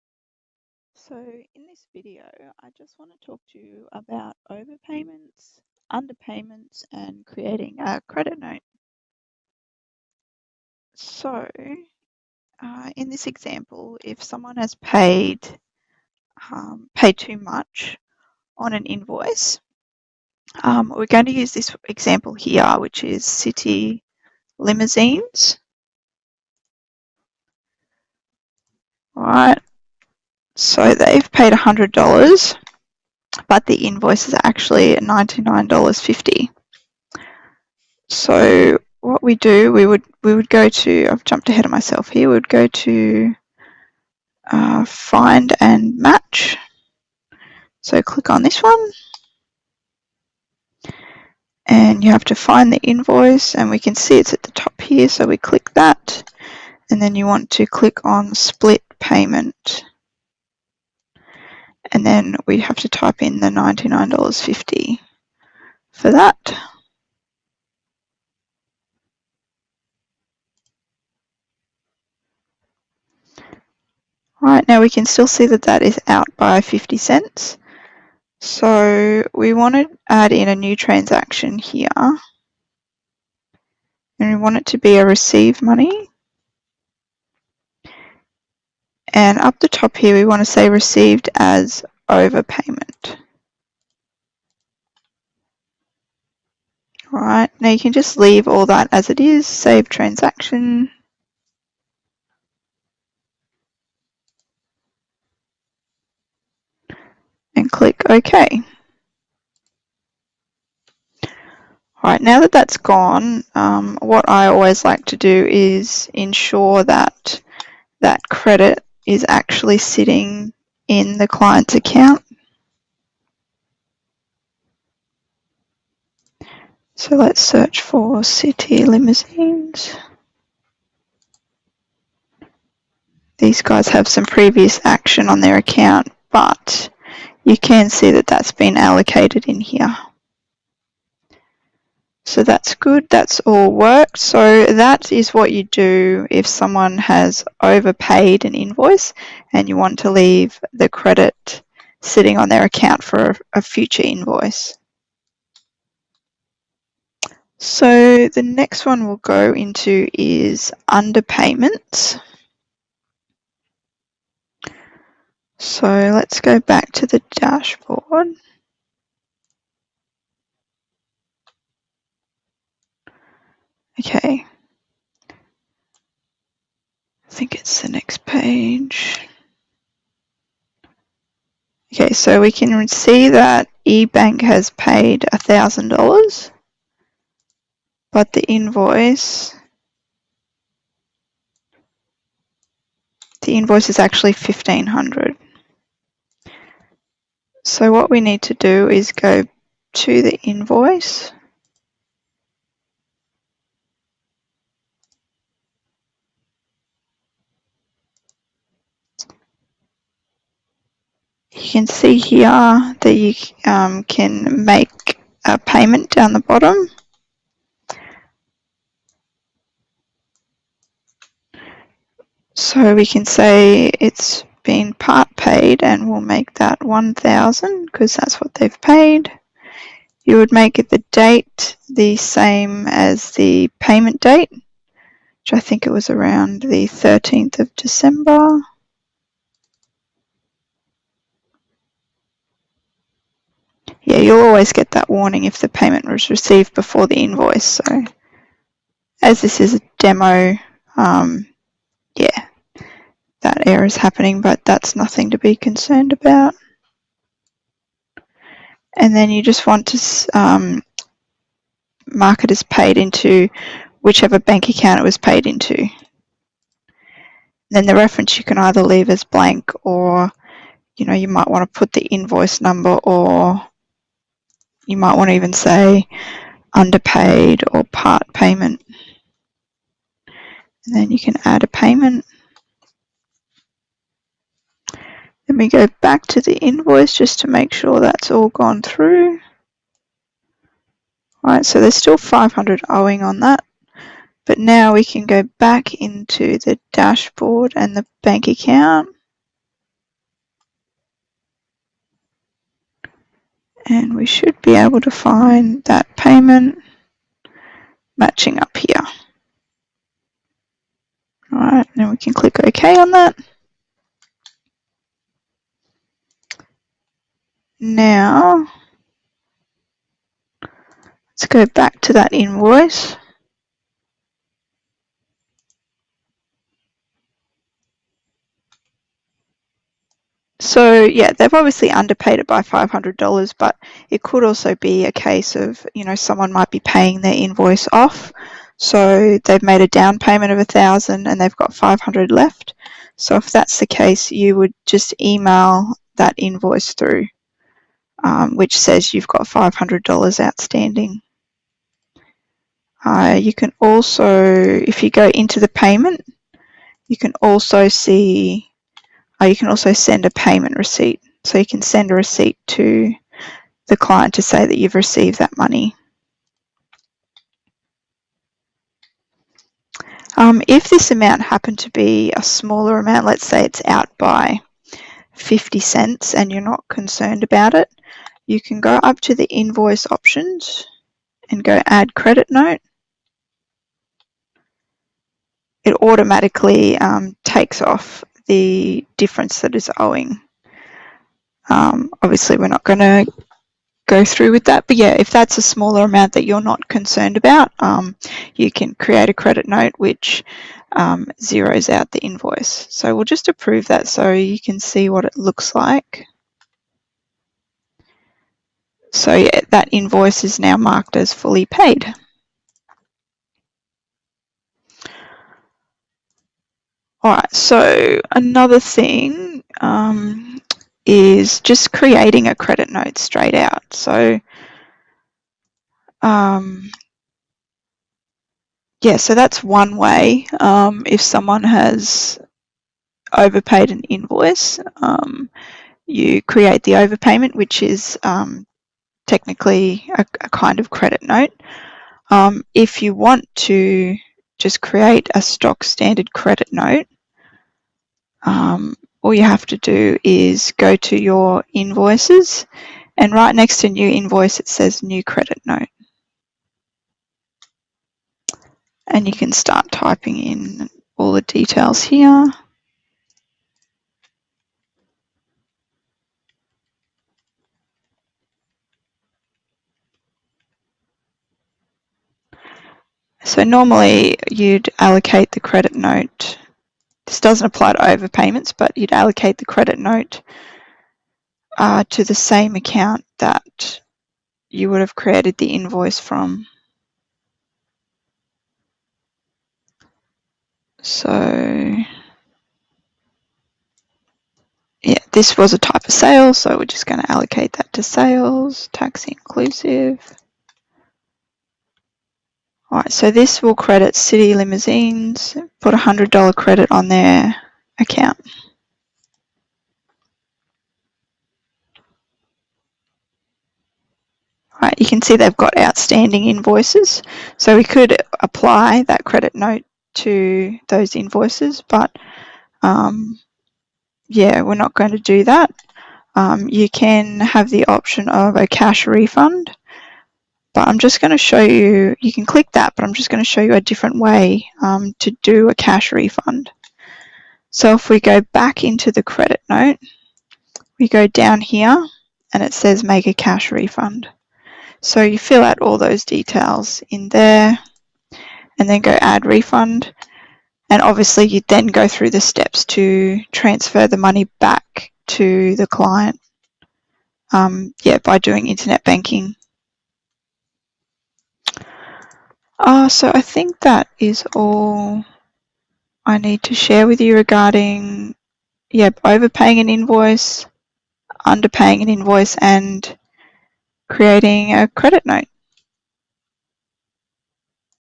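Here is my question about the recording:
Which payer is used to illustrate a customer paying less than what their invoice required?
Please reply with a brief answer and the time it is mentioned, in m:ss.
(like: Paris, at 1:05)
eBank, at 3:03.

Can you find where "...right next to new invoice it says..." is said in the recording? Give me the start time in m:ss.
7:33.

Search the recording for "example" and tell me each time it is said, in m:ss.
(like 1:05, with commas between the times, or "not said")
0:13, 0:21.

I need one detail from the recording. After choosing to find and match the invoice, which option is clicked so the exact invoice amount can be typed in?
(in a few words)
split payment.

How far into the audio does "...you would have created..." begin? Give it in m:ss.
8:04.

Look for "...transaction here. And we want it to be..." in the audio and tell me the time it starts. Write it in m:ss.
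1:20.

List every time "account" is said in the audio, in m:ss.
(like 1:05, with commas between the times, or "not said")
2:01, 2:15, 2:32, 4:24, 4:58, 8:02, 8:28.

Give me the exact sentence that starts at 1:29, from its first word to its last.
And up the top here, we want to say received as overpayment.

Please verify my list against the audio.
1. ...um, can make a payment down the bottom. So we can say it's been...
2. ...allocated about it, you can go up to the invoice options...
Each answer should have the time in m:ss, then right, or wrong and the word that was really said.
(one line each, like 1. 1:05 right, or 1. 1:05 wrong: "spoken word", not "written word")
1. 3:33 right
2. 6:16 wrong: "concerned", not "allocated".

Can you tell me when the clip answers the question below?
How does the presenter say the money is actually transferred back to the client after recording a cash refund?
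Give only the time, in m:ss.
9:18.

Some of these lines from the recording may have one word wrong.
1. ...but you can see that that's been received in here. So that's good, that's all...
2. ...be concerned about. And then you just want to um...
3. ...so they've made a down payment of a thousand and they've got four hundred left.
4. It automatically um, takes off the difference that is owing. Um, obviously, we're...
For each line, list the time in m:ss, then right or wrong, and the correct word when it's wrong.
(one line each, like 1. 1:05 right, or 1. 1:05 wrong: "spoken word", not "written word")
1. 2:16 wrong: "allocated", not "received"
2. 4:15 right
3. 5:38 wrong: "five", not "four"
4. 6:25 right.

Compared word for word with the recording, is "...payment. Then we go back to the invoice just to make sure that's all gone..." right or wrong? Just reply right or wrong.
right.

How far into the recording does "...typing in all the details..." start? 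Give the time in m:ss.
7:39.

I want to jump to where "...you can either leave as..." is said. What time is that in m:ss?
4:28.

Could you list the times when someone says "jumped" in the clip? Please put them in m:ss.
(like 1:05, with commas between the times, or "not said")
0:41.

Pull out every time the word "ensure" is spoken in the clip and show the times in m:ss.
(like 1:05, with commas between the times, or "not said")
1:56.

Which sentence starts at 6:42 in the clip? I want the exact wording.
So we'll just approve that so you can see what it looks like.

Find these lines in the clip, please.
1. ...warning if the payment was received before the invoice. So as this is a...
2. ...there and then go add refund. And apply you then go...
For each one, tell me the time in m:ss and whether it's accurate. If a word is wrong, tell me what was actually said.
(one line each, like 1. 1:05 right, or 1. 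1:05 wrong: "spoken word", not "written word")
1. 4:05 right
2. 9:07 wrong: "obviously", not "apply".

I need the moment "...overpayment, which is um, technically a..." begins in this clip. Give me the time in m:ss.
7:16.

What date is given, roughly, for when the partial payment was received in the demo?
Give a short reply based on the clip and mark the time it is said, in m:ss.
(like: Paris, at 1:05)
13th of December, at 3:56.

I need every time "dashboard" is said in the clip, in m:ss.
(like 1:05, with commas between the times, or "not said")
2:47, 4:56.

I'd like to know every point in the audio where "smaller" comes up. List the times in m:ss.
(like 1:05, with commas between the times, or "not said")
6:12, 6:35.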